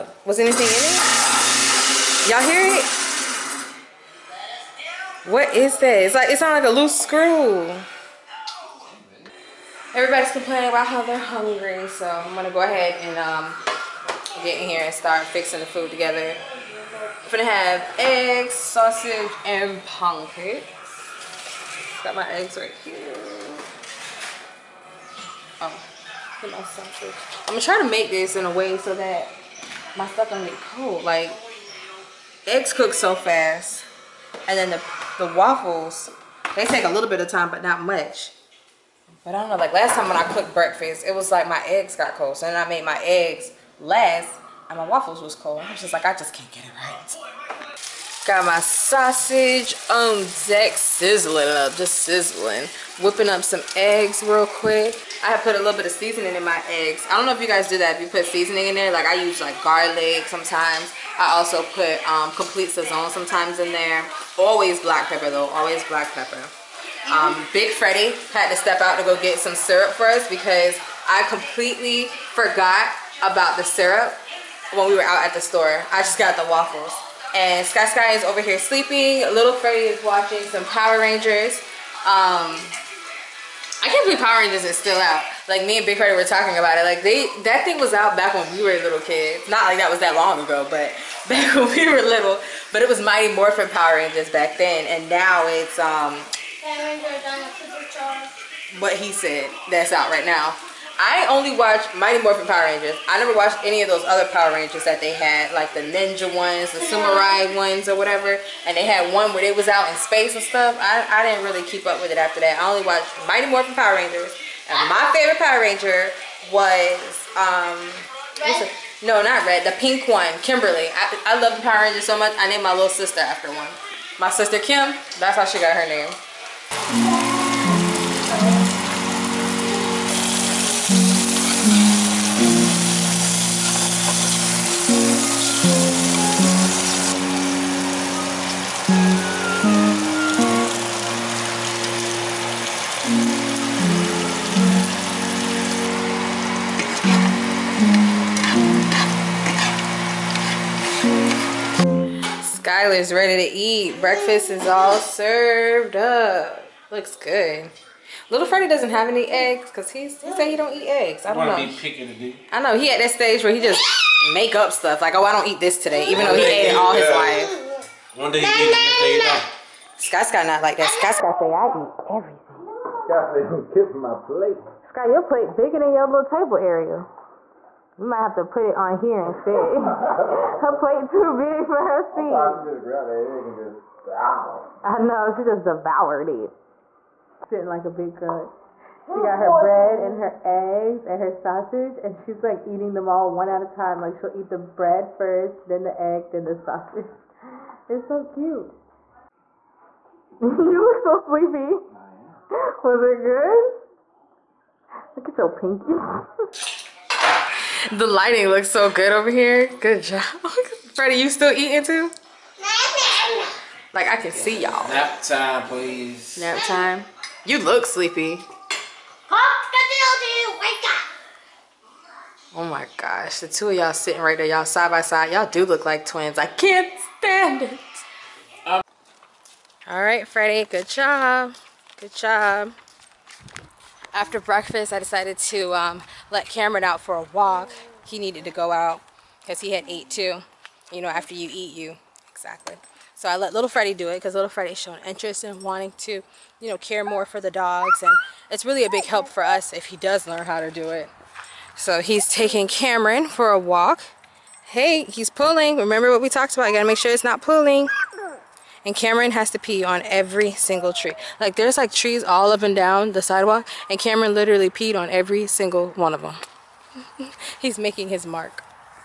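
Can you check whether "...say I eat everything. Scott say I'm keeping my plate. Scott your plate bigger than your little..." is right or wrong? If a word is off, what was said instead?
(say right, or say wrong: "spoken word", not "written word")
right.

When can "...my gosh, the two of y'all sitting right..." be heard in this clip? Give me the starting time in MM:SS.
03:42.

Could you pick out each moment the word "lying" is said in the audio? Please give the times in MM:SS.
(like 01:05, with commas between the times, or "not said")
not said.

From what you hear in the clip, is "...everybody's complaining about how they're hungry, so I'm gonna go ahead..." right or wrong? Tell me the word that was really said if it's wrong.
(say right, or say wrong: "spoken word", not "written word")
right.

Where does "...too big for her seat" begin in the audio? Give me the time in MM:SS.
03:01.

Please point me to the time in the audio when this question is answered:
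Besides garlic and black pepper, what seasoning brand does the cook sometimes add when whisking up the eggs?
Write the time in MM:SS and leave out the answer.
01:02.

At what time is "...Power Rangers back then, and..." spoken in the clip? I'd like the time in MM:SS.
01:33.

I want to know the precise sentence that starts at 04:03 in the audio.
So I let little Freddie do it because little Freddie's shown interest in wanting to, you know, care more for the dogs.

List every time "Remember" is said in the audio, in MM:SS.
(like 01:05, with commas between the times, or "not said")
04:15.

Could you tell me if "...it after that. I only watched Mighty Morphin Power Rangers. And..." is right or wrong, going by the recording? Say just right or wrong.
right.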